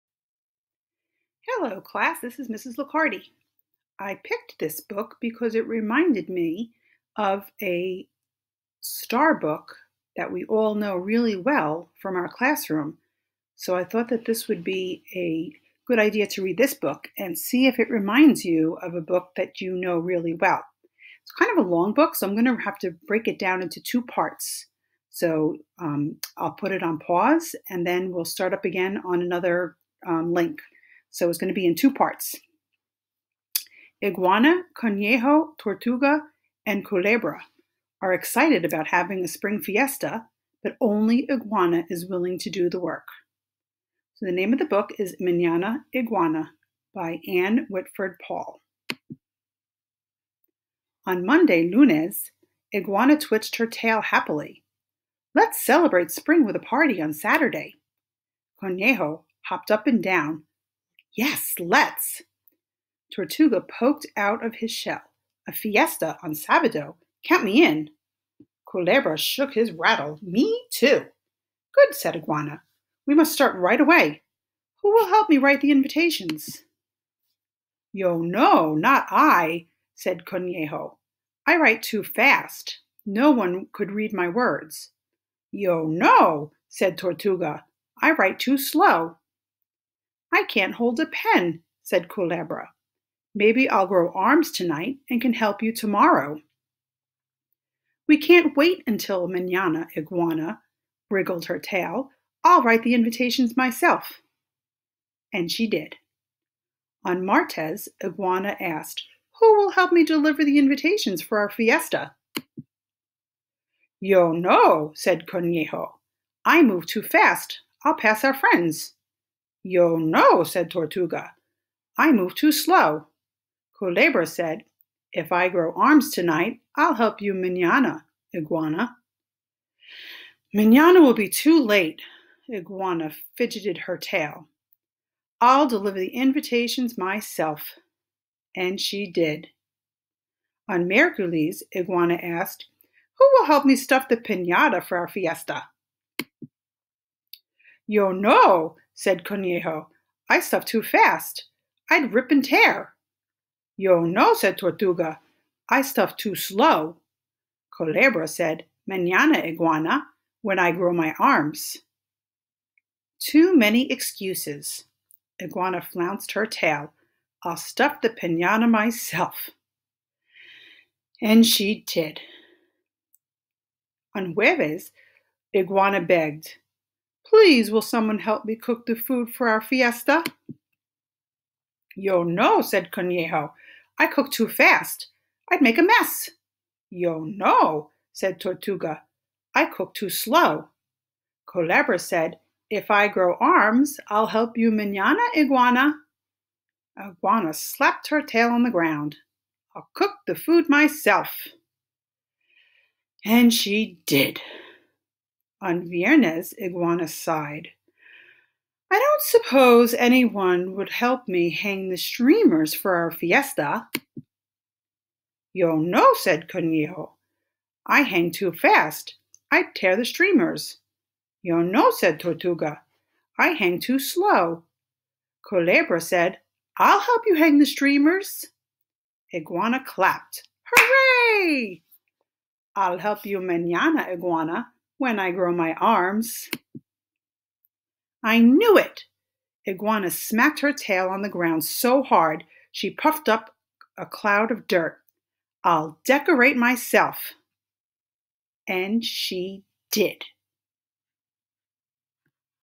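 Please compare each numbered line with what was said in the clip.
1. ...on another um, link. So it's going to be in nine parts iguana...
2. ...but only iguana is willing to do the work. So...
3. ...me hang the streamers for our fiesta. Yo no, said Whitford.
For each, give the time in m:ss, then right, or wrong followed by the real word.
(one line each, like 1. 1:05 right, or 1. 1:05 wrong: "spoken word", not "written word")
1. 0:29 wrong: "two", not "nine"
2. 0:40 right
3. 3:31 wrong: "Conejo", not "Whitford".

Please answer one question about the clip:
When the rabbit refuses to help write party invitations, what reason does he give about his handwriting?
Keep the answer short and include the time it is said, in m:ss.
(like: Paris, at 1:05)
I write too fast, at 1:21.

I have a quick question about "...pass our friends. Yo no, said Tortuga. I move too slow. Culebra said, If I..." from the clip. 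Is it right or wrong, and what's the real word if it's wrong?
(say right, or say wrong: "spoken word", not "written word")
right.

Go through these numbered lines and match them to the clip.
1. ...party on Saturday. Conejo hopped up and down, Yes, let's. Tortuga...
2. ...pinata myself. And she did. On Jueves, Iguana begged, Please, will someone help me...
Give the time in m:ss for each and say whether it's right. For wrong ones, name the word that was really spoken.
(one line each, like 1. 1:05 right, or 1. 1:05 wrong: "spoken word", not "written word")
1. 0:56 right
2. 2:48 right.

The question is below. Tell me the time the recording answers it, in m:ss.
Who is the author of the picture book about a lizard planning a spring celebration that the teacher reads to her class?
0:47.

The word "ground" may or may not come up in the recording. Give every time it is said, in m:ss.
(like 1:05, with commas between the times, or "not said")
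3:18, 4:01.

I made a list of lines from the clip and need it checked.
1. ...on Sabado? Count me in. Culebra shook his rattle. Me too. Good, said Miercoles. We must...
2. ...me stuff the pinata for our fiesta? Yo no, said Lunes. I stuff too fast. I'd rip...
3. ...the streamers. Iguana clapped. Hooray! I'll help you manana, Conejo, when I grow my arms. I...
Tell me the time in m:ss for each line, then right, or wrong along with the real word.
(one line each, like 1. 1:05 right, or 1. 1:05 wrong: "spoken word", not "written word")
1. 1:06 wrong: "Iguana", not "Miercoles"
2. 2:23 wrong: "Conejo", not "Lunes"
3. 3:47 wrong: "Iguana", not "Conejo".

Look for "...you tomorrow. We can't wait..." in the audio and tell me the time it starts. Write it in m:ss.
1:35.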